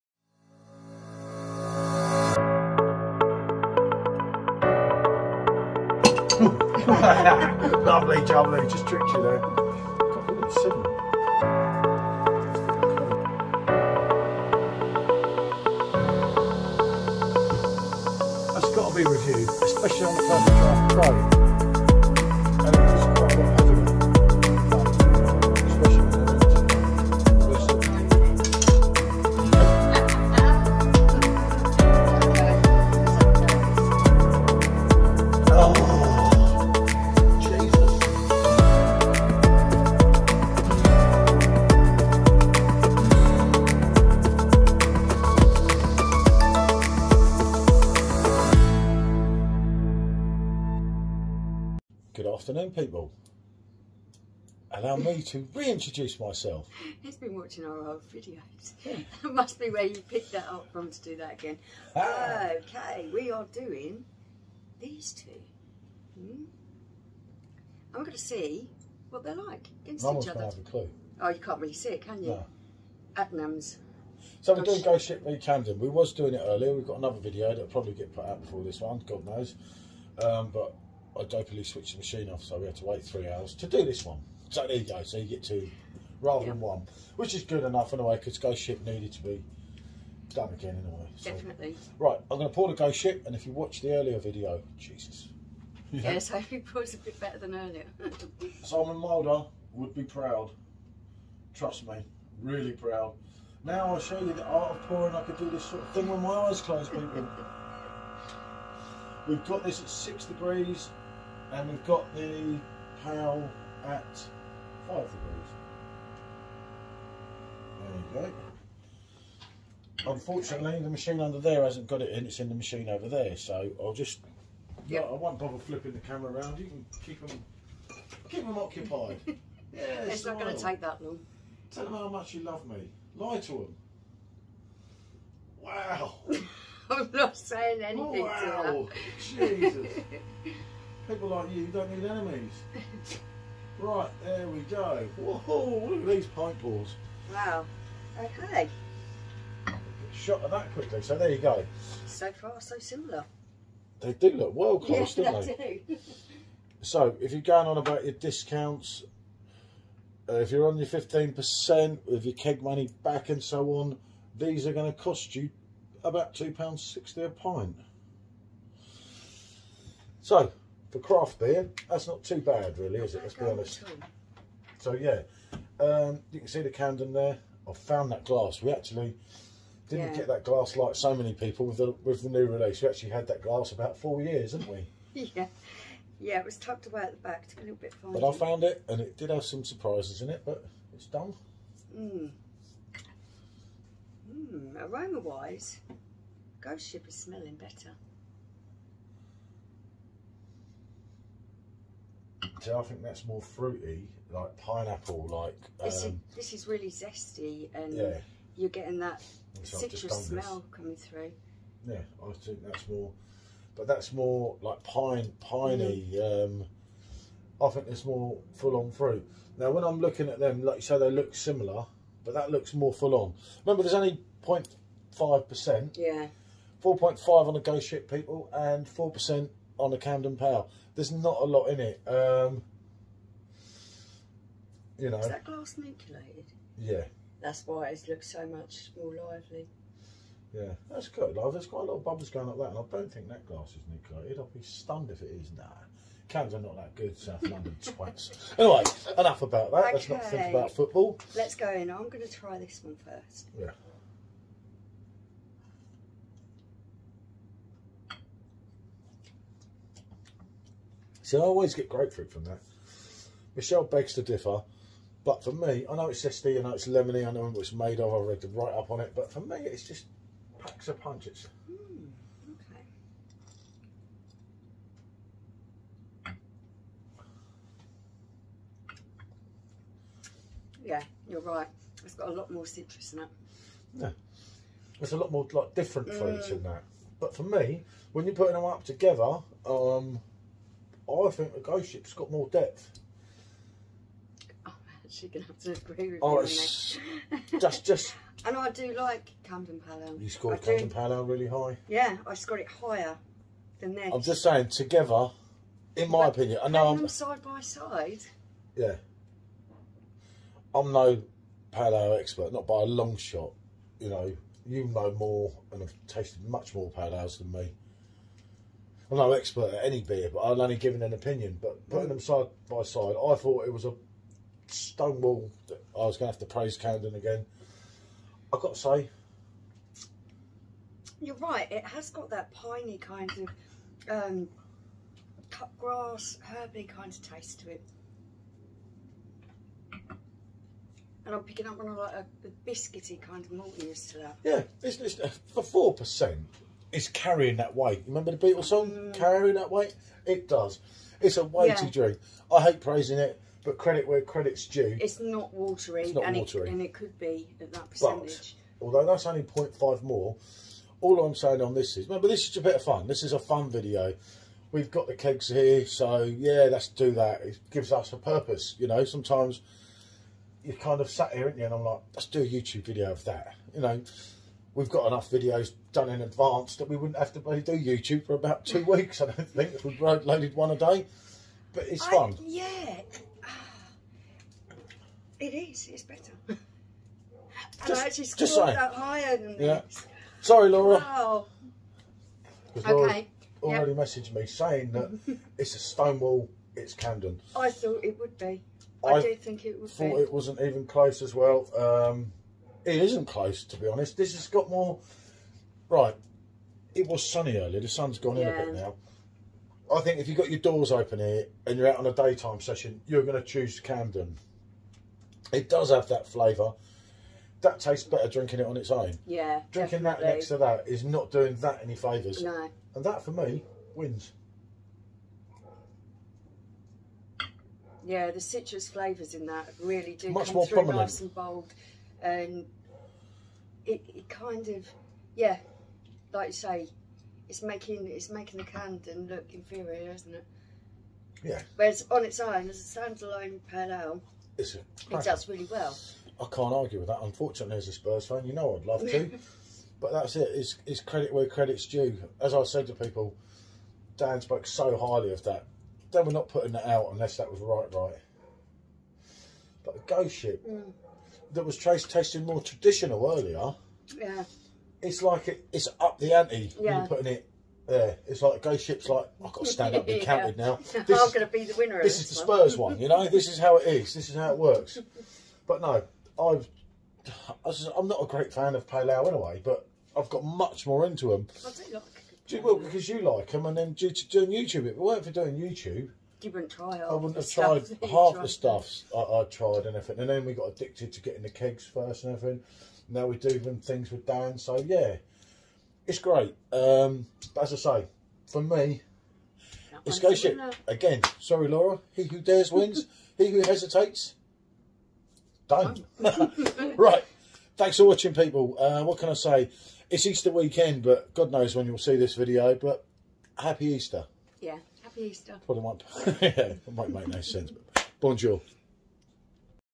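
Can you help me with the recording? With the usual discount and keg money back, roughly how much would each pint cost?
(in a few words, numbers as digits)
£2.60.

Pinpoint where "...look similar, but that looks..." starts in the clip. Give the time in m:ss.
3:41.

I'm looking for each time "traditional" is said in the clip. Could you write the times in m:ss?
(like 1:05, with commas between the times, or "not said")
7:42.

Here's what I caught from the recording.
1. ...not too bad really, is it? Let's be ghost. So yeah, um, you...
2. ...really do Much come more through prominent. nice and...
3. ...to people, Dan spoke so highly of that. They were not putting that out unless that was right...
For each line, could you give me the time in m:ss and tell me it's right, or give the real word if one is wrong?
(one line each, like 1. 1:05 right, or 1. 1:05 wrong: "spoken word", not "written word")
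1. 2:52 wrong: "honest", not "ghost"
2. 7:09 right
3. 7:32 right.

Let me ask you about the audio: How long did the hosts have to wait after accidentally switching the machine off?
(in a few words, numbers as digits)
3 hours.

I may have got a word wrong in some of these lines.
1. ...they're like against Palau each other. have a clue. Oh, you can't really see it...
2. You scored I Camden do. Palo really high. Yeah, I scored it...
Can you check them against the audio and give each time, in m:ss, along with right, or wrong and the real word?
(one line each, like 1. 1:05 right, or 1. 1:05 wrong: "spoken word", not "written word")
1. 1:09 wrong: "Mum", not "Palau"
2. 5:00 right.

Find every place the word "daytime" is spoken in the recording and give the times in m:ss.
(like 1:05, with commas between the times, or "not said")
6:52.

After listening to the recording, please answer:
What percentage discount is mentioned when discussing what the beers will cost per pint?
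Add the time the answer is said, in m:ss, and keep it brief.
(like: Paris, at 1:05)
15%, at 2:40.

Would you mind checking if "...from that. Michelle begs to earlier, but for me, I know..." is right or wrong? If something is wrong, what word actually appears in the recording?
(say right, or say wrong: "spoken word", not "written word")
wrong: "differ", not "earlier".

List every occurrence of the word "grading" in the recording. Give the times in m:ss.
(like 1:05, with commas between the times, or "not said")
not said.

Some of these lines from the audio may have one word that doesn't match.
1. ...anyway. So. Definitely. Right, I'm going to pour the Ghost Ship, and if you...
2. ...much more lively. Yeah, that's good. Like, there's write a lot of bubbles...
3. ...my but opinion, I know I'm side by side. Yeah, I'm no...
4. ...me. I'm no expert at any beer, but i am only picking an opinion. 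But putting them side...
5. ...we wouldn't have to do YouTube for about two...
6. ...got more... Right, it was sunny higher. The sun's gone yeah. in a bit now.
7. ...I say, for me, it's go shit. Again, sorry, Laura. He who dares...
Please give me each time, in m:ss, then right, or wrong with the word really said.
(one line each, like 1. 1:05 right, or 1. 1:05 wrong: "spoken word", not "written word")
1. 1:30 right
2. 3:58 wrong: "quite", not "write"
3. 5:06 right
4. 5:17 wrong: "giving", not "picking"
5. 6:16 right
6. 6:44 wrong: "earlier", not "higher"
7. 8:17 right.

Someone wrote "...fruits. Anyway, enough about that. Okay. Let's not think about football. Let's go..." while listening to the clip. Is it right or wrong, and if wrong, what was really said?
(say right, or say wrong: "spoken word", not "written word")
wrong: "twats", not "fruits".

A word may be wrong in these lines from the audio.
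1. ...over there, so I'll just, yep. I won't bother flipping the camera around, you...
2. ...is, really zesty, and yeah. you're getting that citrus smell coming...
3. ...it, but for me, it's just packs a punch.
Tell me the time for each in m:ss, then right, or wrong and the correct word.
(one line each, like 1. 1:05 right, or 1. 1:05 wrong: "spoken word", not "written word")
1. 2:02 right
2. 3:26 right
3. 4:29 right.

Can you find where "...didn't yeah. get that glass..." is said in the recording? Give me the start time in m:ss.
2:59.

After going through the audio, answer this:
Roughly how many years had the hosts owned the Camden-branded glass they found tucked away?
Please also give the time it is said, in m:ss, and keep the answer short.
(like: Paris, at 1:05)
4 years, at 3:03.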